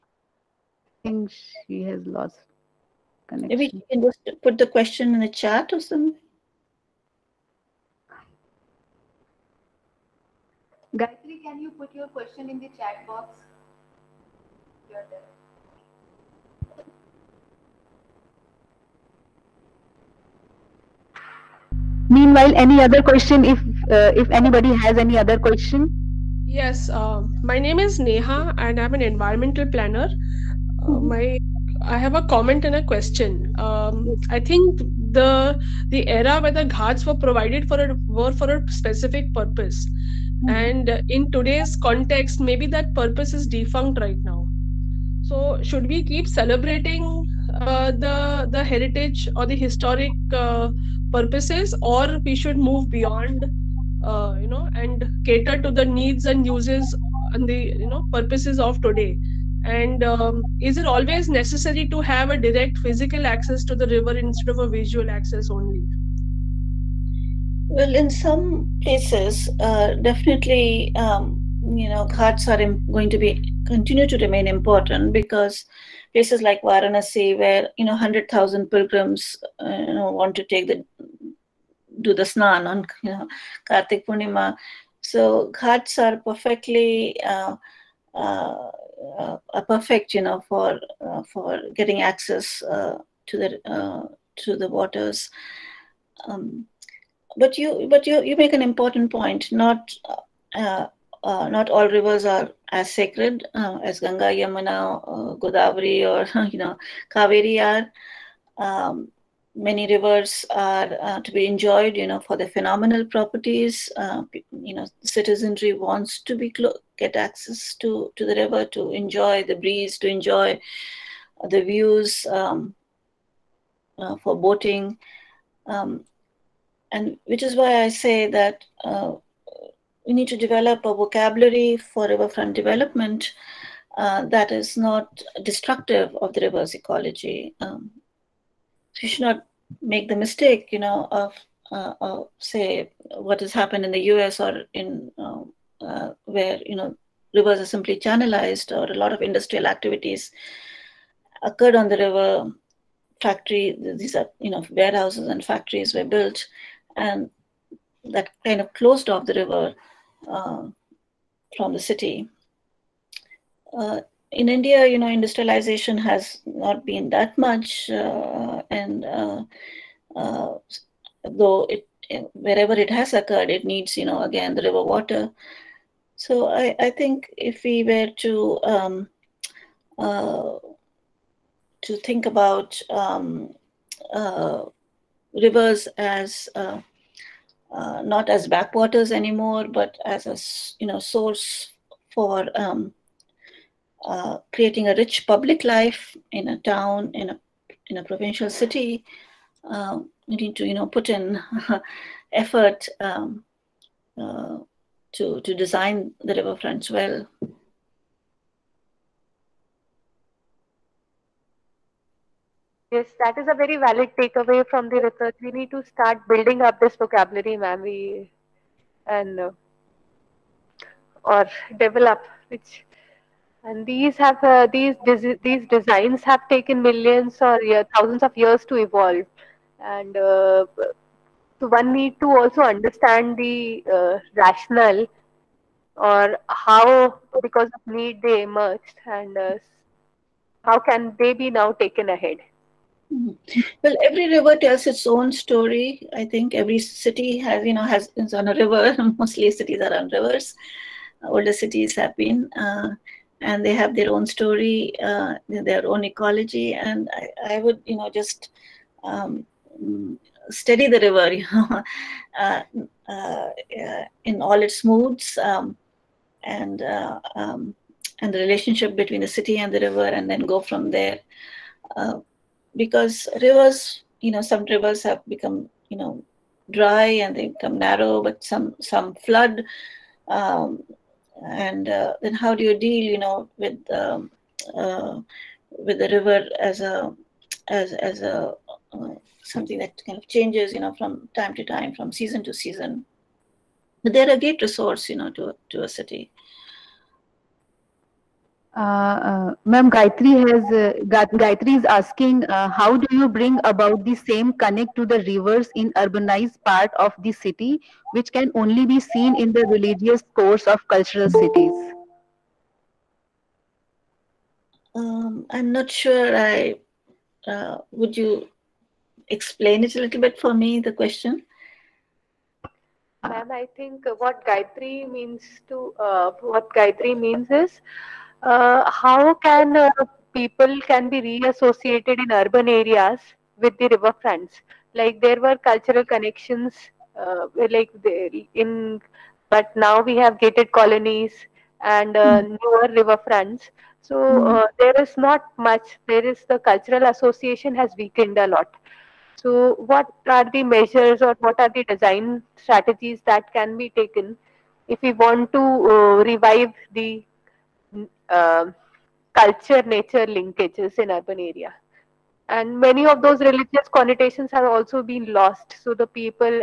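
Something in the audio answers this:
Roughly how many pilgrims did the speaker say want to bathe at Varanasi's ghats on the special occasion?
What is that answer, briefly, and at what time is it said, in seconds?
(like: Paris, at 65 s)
100,000, at 77 s.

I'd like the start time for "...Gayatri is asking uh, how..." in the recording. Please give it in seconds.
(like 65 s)
301 s.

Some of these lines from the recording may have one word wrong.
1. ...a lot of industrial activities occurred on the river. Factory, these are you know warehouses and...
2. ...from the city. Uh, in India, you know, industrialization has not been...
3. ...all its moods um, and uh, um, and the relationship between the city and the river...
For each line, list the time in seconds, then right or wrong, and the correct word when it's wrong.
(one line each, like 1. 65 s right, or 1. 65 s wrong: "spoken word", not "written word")
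1. 148 s right
2. 161 s right
3. 264 s right.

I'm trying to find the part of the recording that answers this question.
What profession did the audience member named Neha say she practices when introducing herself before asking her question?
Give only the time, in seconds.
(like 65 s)
29 s.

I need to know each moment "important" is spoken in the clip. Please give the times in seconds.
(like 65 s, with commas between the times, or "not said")
74 s, 98 s.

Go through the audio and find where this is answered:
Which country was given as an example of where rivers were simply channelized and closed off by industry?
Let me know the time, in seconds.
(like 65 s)
144 s.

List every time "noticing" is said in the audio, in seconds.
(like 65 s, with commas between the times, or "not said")
not said.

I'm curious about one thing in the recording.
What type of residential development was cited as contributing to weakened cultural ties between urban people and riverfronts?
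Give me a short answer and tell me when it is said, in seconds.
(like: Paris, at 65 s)
Gated colonies, at 340 s.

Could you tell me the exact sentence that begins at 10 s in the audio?
Gayatri, can you put your question in the chat box?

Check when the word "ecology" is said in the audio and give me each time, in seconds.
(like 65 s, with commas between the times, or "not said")
136 s, 256 s.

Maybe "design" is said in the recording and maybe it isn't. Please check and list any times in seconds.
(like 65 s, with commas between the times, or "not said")
205 s, 225 s, 351 s.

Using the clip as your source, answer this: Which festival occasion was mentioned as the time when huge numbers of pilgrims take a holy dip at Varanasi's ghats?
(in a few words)
Kartik Purnima.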